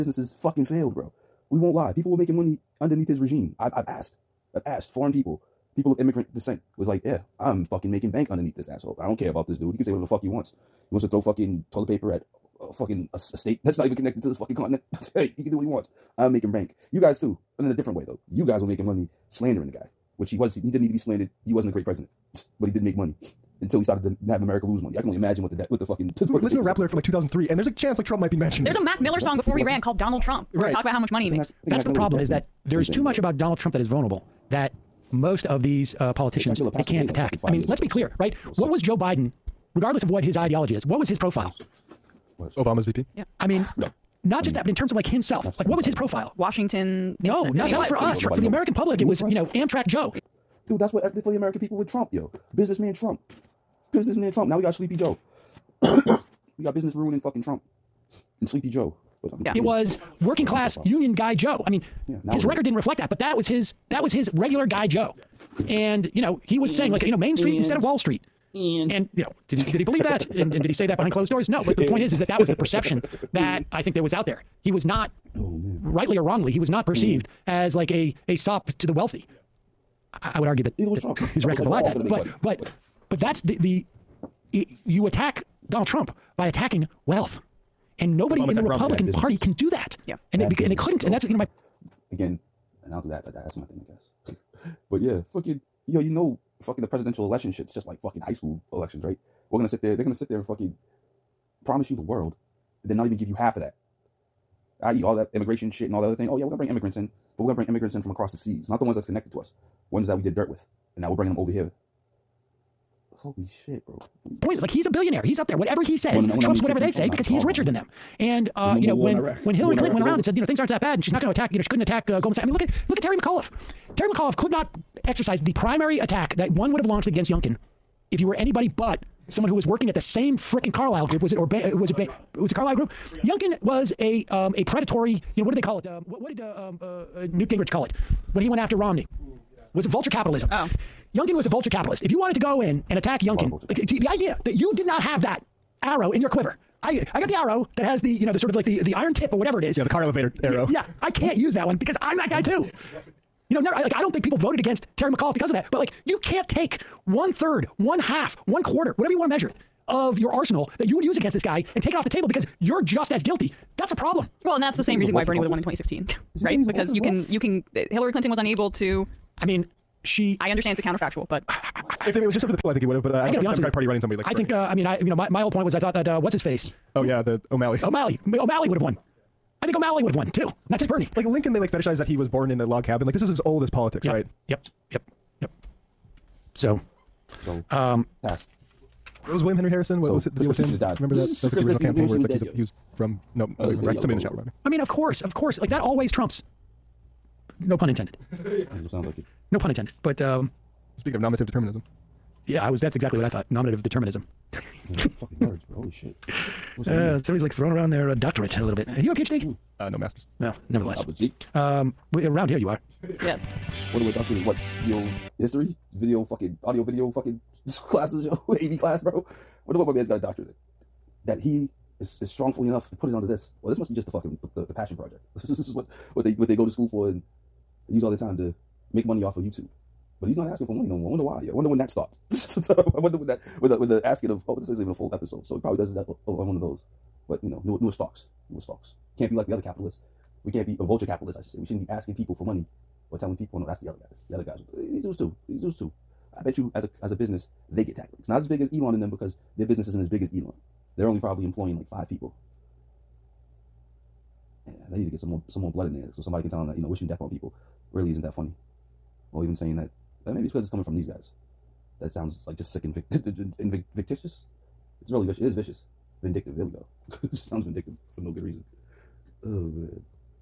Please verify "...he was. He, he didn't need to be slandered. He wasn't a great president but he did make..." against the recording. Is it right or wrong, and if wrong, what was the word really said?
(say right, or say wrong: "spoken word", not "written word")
right.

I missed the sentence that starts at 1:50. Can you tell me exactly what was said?
And now we're bringing them over here.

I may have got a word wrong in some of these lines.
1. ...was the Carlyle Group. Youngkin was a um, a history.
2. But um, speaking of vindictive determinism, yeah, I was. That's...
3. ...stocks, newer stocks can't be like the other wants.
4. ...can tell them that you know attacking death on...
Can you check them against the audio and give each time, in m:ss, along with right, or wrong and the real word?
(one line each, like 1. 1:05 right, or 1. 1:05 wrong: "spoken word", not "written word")
1. 2:12 wrong: "predatory", not "history"
2. 3:20 wrong: "nominative", not "vindictive"
3. 3:57 wrong: "capitalists", not "wants"
4. 4:16 wrong: "wishing", not "attacking".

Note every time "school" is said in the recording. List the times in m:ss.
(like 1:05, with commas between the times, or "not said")
1:38, 3:46.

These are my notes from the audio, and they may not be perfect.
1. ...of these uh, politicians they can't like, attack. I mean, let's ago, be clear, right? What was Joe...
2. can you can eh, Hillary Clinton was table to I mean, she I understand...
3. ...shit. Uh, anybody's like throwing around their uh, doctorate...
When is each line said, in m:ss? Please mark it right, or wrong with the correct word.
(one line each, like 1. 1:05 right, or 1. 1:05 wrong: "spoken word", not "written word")
1. 0:35 right
2. 2:47 wrong: "unable", not "table"
3. 3:25 wrong: "somebody", not "anybody".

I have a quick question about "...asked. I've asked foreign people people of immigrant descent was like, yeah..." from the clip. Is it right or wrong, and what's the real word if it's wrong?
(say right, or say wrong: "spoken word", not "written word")
right.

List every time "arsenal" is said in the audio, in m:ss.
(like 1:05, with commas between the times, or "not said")
2:40.